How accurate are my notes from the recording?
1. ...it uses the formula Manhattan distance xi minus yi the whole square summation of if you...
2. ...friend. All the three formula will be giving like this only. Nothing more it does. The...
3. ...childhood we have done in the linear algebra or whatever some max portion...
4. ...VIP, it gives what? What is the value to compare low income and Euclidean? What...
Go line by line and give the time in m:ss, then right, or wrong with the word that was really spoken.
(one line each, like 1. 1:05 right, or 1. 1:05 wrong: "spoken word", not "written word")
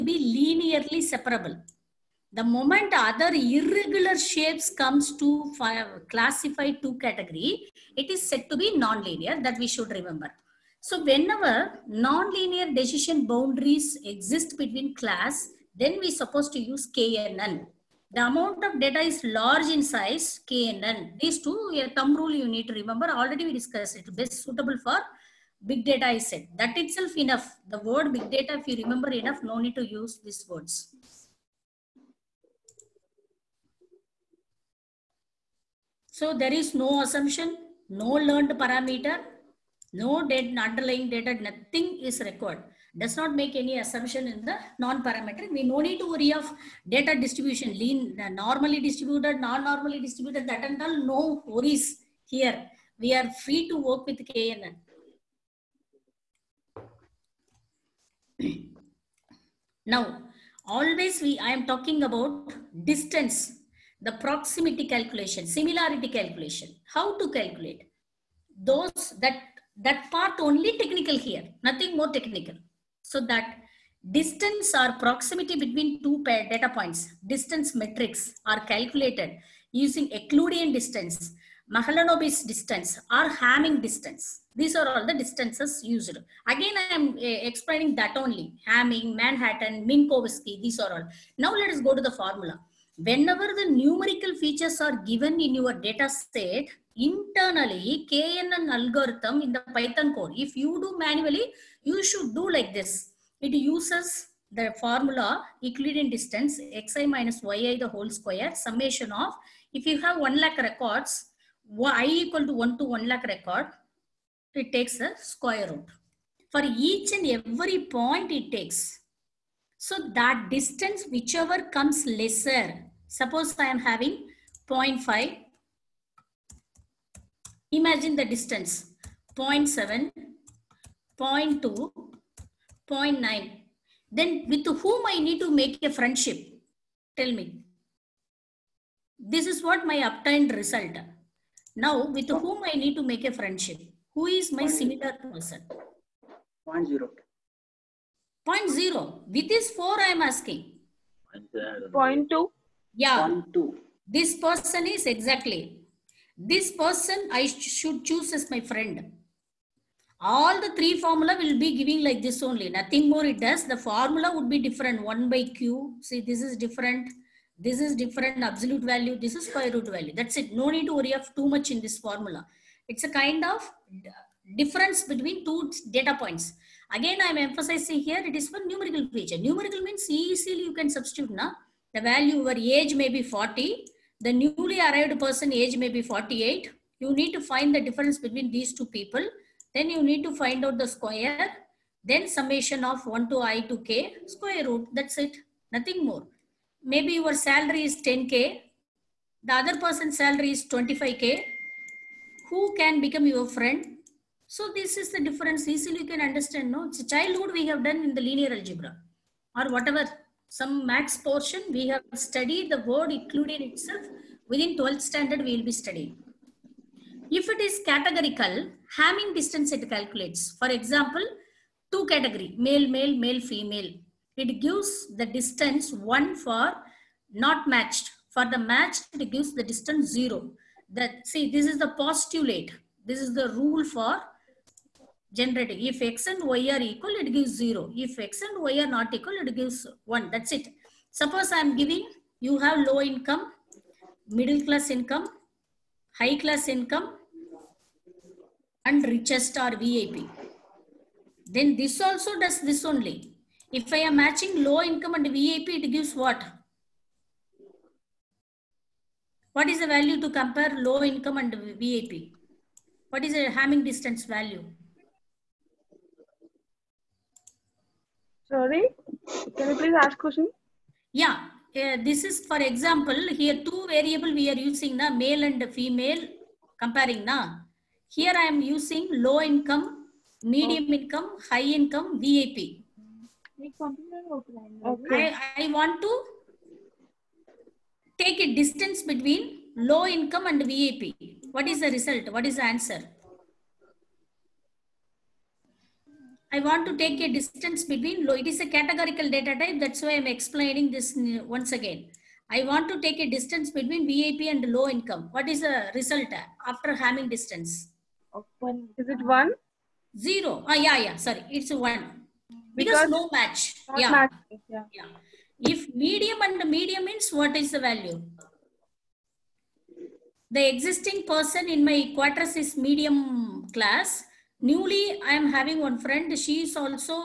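1. 1:43 wrong: "Euclidean", not "Manhattan"
2. 2:38 right
3. 3:27 right
4. 4:15 wrong: "VIP", not "Euclidean".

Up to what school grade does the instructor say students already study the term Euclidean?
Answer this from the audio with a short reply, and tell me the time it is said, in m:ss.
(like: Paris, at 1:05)
12th standard, at 3:34.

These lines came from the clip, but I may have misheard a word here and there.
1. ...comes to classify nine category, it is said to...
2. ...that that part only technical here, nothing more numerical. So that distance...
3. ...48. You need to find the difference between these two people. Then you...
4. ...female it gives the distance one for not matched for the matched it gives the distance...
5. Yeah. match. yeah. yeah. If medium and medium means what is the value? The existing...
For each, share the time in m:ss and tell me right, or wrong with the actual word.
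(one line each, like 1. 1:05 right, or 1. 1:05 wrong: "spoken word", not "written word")
1. 0:04 wrong: "two", not "nine"
2. 1:09 wrong: "technical", not "numerical"
3. 3:06 right
4. 3:43 right
5. 5:13 right.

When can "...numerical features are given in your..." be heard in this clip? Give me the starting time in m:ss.
1:33.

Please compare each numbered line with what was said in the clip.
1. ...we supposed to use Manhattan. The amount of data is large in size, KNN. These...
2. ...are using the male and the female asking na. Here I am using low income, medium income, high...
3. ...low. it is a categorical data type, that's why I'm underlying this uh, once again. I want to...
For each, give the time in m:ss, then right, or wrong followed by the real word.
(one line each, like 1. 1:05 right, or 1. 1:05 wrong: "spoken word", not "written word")
1. 0:16 wrong: "KNN", not "Manhattan"
2. 4:34 wrong: "comparing", not "asking"
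3. 4:58 wrong: "explaining", not "underlying".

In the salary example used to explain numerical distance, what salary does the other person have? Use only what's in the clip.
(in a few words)
25k.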